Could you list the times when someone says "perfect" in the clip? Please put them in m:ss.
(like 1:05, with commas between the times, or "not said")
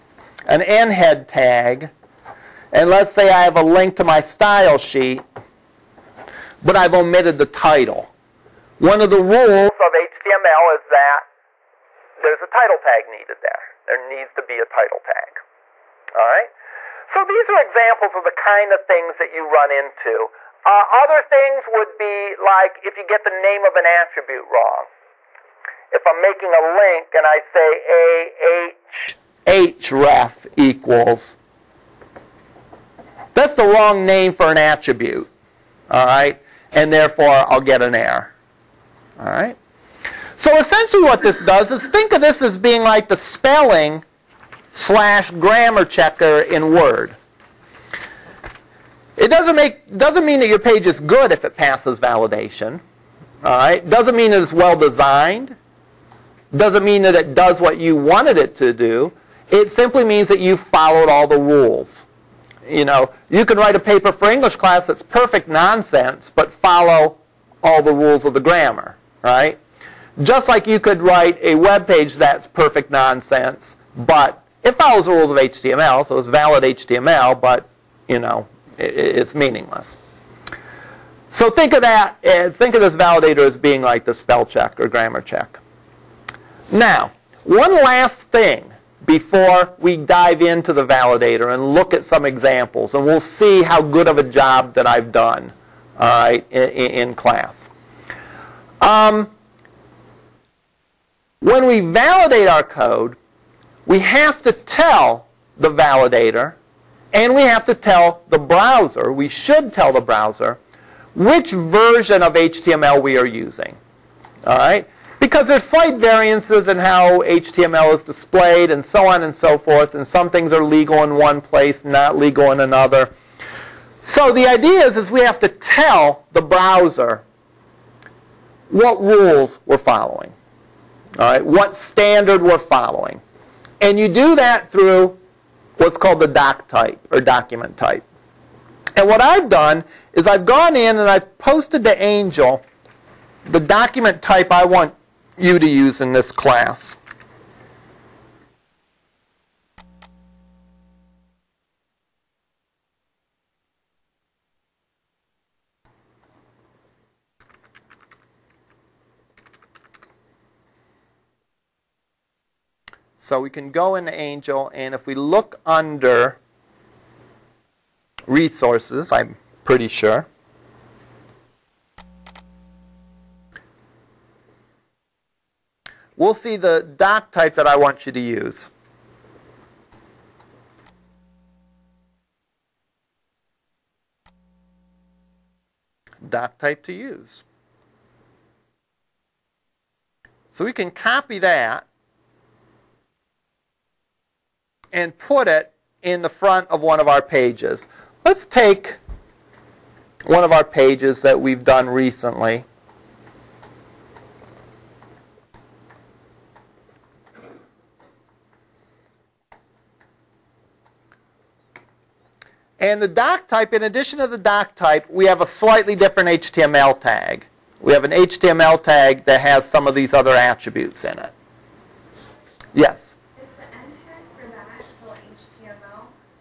1:05, 1:12.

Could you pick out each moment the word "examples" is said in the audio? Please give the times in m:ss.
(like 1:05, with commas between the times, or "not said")
0:17, 1:32.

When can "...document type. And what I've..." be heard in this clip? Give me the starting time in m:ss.
2:17.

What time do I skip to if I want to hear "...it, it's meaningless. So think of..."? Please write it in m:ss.
1:18.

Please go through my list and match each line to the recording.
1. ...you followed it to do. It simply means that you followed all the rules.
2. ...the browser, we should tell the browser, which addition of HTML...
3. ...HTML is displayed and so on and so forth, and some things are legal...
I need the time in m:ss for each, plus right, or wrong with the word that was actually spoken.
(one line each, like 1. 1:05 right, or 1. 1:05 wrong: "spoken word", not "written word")
1. 0:57 wrong: "wanted", not "followed"
2. 1:48 wrong: "version", not "addition"
3. 1:57 right.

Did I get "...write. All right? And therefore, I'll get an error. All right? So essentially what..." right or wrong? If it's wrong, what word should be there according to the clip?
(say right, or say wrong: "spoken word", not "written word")
wrong: "attribute", not "write".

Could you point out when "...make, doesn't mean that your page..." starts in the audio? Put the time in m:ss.
0:49.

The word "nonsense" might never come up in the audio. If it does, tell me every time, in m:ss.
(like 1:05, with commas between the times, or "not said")
1:05, 1:12.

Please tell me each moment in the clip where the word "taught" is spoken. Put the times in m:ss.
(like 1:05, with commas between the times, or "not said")
not said.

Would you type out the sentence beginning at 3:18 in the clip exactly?
Let's take one of our pages that we've done recently.